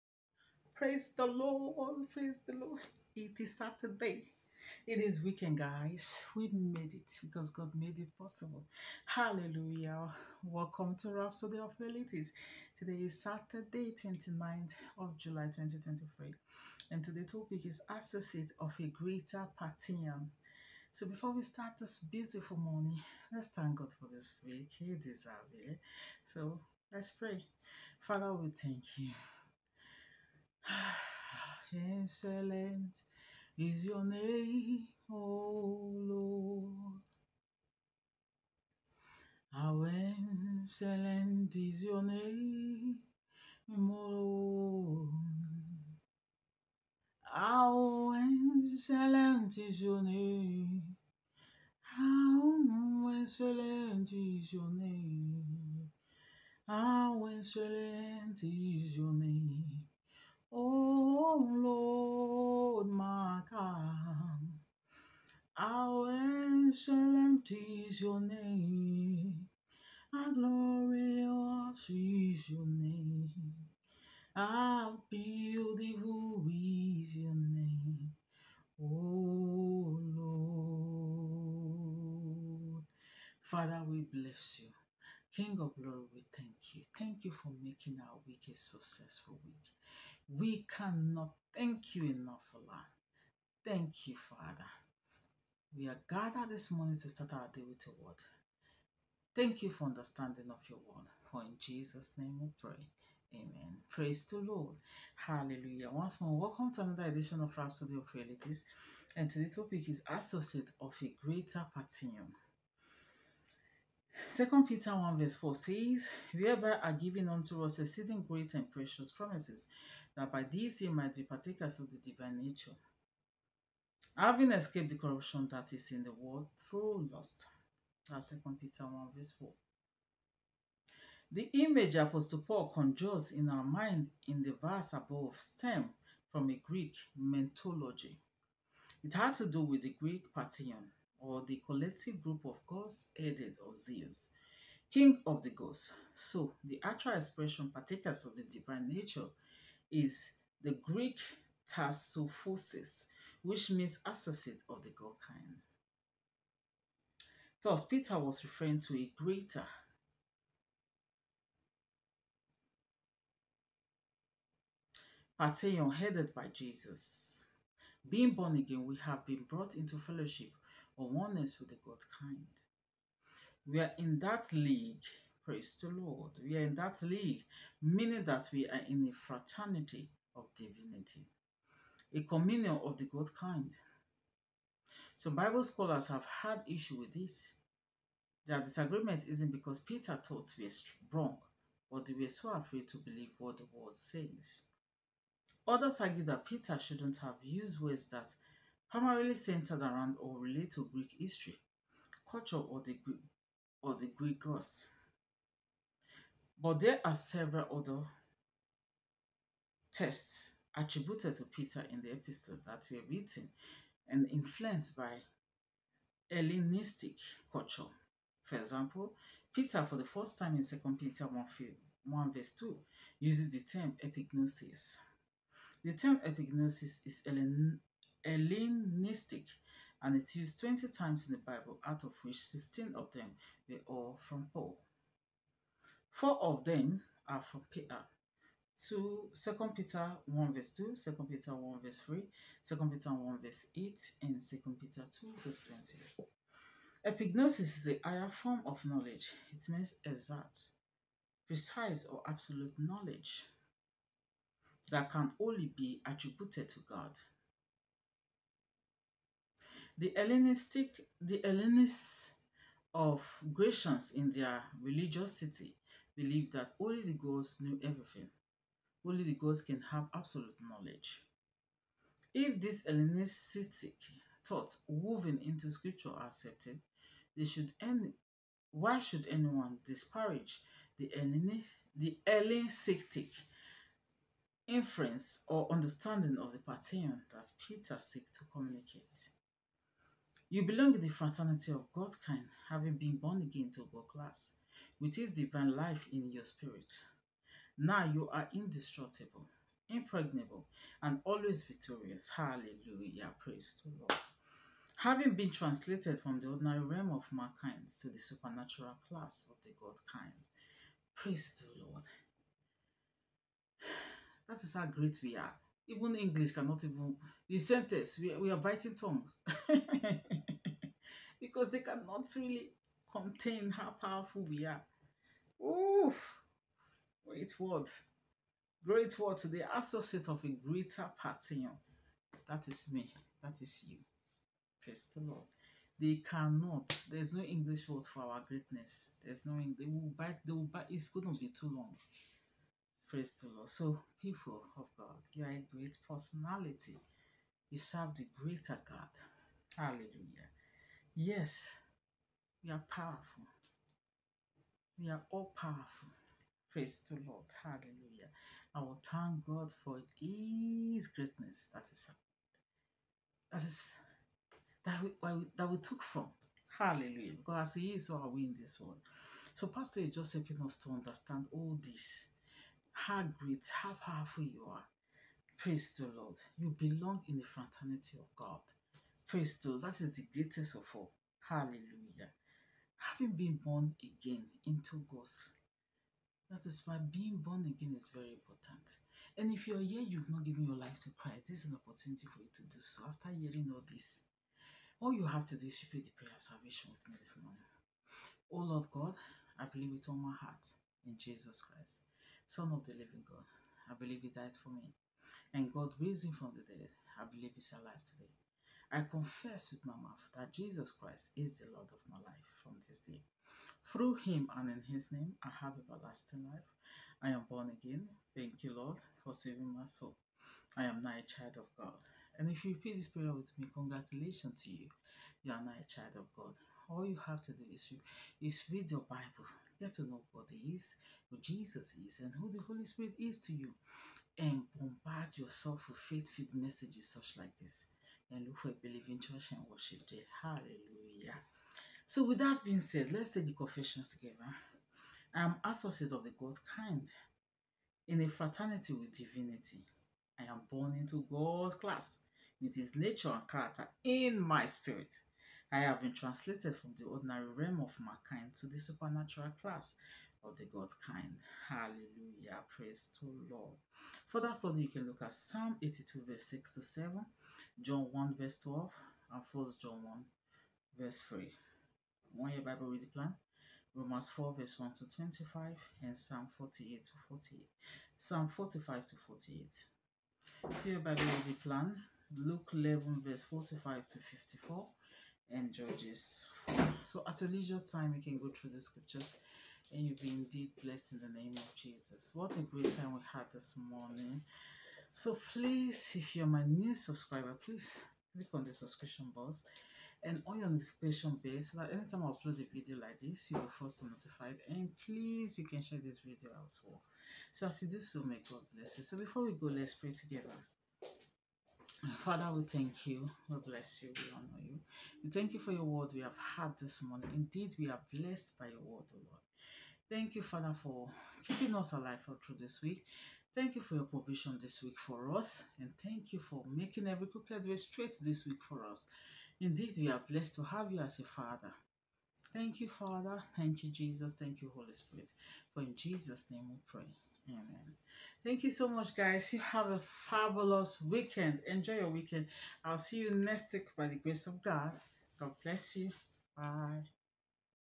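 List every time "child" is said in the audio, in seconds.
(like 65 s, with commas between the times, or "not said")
421 s, 425 s.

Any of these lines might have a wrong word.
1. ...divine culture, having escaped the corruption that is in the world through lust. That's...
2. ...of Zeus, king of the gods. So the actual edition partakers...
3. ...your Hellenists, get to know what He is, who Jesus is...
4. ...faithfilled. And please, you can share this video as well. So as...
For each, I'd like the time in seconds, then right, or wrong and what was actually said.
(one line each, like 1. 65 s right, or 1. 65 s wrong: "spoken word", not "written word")
1. 121 s wrong: "nature", not "culture"
2. 143 s wrong: "expression", not "edition"
3. 428 s wrong: "Bible", not "Hellenists"
4. 504 s wrong: "notified", not "faithfilled".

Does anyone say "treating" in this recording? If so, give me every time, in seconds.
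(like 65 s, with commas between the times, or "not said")
not said.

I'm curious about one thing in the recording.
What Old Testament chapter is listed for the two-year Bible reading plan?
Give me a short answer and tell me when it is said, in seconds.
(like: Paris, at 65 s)
Judges 4, at 485 s.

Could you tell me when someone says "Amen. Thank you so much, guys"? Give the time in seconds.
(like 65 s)
537 s.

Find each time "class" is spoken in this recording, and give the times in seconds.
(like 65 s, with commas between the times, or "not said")
294 s, 309 s, 451 s, 459 s.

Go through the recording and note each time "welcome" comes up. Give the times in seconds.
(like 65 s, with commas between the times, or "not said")
10 s, 106 s.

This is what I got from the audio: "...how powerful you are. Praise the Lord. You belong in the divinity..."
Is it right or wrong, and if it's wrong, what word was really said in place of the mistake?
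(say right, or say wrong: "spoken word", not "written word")
wrong: "fraternity", not "divinity".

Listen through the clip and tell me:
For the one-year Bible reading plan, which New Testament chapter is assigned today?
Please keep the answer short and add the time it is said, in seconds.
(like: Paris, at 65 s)
Romans 4, at 473 s.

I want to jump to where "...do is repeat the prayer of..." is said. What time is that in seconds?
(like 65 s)
395 s.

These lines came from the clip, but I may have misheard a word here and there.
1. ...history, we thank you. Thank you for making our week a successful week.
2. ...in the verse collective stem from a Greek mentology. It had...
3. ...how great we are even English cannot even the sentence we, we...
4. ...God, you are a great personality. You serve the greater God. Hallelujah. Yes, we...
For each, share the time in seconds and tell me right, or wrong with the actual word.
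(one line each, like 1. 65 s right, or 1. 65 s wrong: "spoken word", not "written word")
1. 85 s wrong: "glory", not "history"
2. 134 s wrong: "above", not "collective"
3. 314 s right
4. 344 s right.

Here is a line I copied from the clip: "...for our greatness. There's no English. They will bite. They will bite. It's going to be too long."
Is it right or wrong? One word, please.
right.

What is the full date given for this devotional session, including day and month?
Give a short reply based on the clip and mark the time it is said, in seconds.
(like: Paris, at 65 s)
Saturday, 29th of July, 2023, at 13 s.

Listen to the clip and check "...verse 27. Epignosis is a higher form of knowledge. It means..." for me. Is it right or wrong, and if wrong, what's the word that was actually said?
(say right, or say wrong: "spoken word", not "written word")
wrong: "20", not "27".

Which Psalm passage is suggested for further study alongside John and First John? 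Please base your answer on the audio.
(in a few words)
Psalm 82:6-7.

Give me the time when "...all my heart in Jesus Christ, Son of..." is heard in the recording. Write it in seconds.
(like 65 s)
400 s.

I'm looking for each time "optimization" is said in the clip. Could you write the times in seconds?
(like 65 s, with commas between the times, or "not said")
not said.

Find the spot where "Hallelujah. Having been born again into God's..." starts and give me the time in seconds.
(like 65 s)
381 s.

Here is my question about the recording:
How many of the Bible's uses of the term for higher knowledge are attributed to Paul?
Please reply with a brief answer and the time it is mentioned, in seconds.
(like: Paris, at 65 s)
16, at 232 s.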